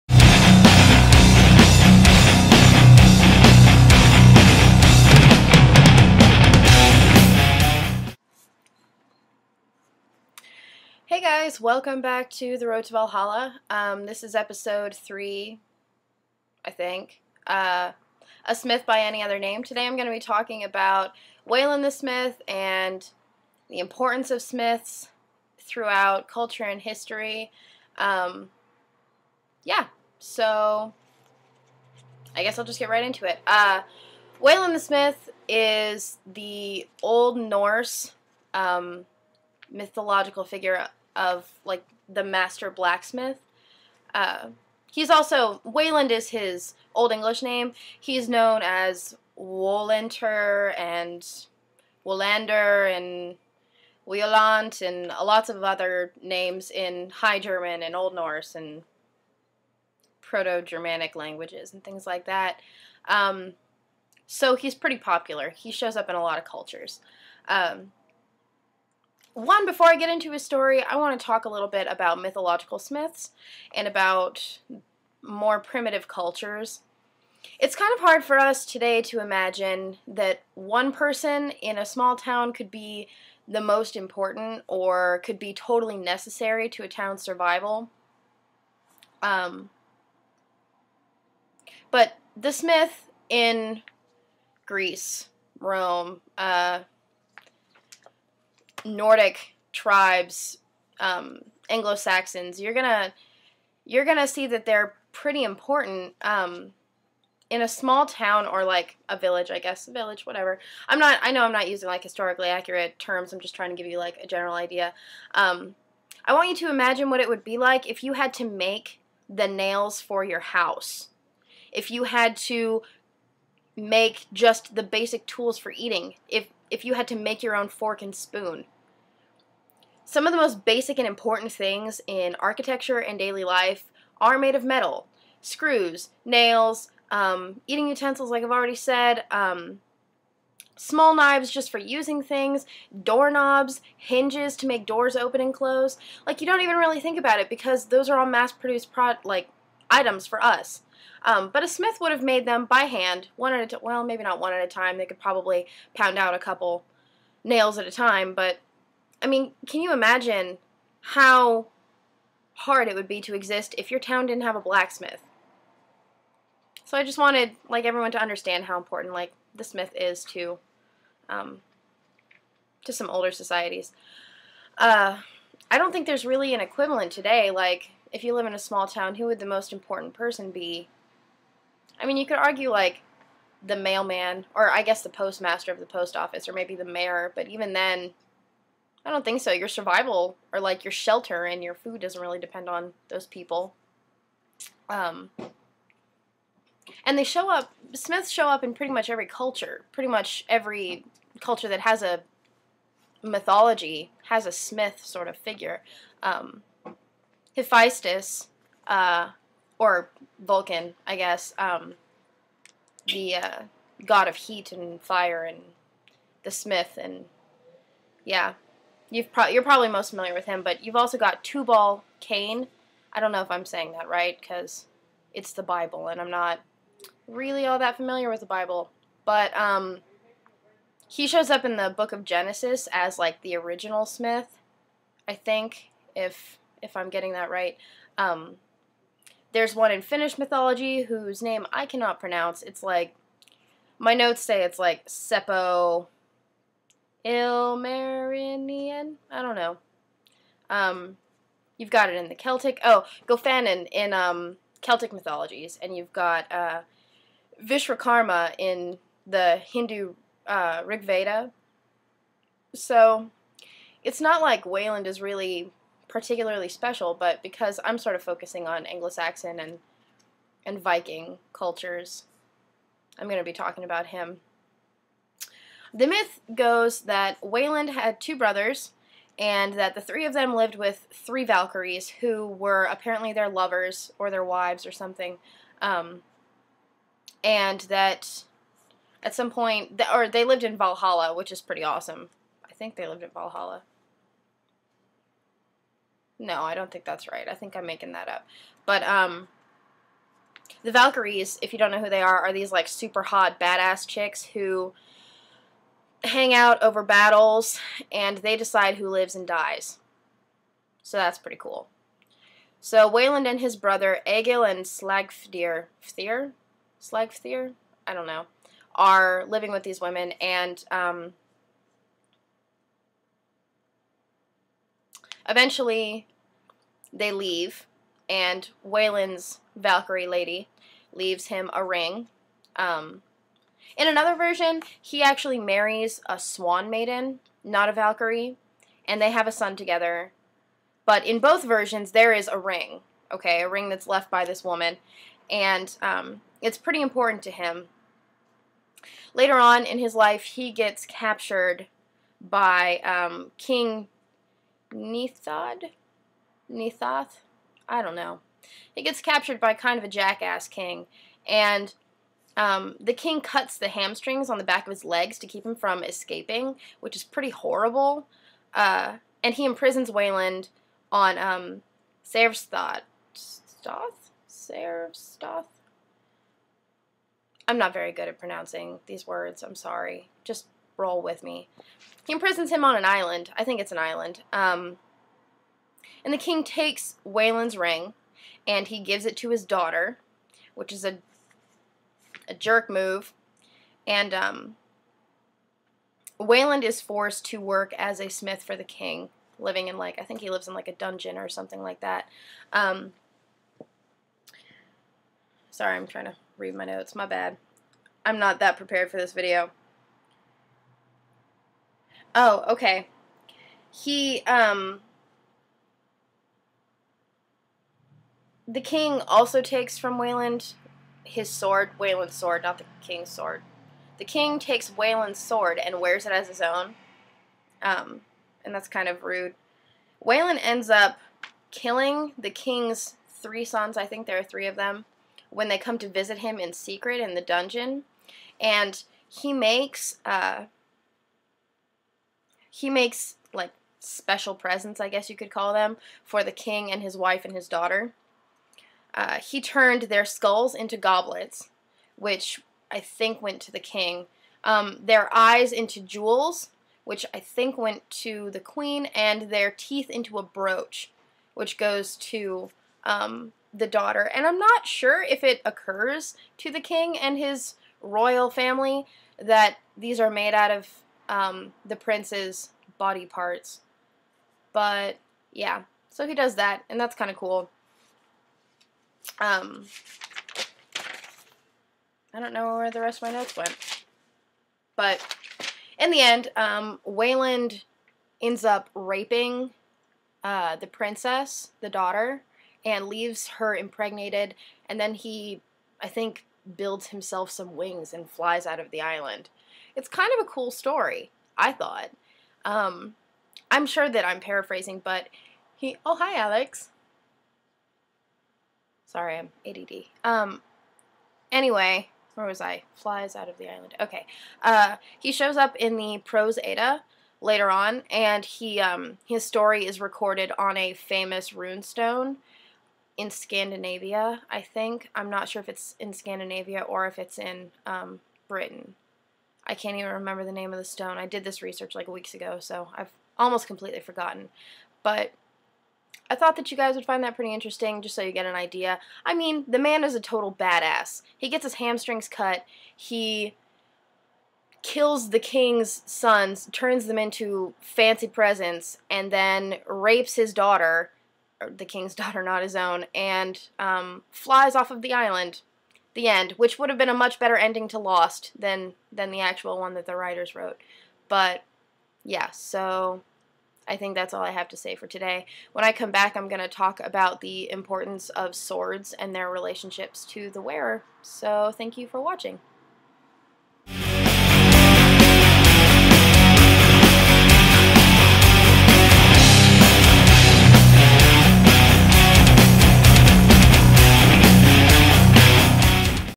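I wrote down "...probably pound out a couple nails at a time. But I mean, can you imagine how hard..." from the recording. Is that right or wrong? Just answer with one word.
right.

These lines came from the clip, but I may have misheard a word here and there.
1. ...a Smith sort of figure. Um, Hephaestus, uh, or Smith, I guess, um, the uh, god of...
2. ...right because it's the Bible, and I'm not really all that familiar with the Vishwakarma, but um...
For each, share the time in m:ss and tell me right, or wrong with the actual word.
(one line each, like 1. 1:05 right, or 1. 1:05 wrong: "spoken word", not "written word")
1. 3:24 wrong: "Vulcan", not "Smith"
2. 3:44 wrong: "Bible", not "Vishwakarma".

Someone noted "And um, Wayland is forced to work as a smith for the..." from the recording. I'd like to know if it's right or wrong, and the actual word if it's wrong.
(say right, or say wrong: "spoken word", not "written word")
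right.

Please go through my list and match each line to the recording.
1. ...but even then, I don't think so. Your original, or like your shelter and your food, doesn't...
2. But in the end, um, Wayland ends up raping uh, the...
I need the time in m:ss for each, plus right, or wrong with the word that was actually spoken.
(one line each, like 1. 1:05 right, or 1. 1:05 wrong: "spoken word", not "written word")
1. 3:07 wrong: "survival", not "original"
2. 8:04 right.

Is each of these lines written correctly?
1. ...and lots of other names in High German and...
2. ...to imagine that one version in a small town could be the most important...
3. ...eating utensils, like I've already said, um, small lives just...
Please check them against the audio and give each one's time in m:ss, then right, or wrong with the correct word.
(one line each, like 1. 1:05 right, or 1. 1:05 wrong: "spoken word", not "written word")
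1. 0:54 right
2. 1:19 wrong: "person", not "version"
3. 2:17 wrong: "knives", not "lives".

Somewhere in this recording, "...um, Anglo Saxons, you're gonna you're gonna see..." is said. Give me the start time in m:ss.
1:40.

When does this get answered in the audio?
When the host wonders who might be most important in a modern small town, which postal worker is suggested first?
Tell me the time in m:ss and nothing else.
3:03.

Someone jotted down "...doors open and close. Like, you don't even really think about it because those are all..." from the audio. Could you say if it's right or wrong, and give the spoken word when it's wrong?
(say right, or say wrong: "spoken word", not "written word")
right.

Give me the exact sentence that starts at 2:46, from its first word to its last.
So I just wanted like everyone to understand how important like the smith is to um, to some older societies.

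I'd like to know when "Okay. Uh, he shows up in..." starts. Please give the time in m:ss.
8:33.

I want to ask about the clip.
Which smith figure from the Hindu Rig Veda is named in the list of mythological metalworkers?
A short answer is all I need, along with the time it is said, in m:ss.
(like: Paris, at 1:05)
Vishwakarma, at 4:17.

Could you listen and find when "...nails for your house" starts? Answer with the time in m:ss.
1:59.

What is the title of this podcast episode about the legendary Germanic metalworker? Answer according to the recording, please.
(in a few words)
A Smith by Any Other Name.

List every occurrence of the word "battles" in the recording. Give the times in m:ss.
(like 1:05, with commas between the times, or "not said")
5:07.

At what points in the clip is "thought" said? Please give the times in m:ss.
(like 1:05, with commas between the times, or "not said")
8:21, 8:56.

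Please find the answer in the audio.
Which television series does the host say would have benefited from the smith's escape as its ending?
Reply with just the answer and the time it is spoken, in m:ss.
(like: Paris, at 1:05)
Lost, at 9:17.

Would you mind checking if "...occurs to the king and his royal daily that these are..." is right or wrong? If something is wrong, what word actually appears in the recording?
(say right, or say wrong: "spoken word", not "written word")
wrong: "family", not "daily".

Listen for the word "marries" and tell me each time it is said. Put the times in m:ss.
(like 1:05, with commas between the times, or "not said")
5:35.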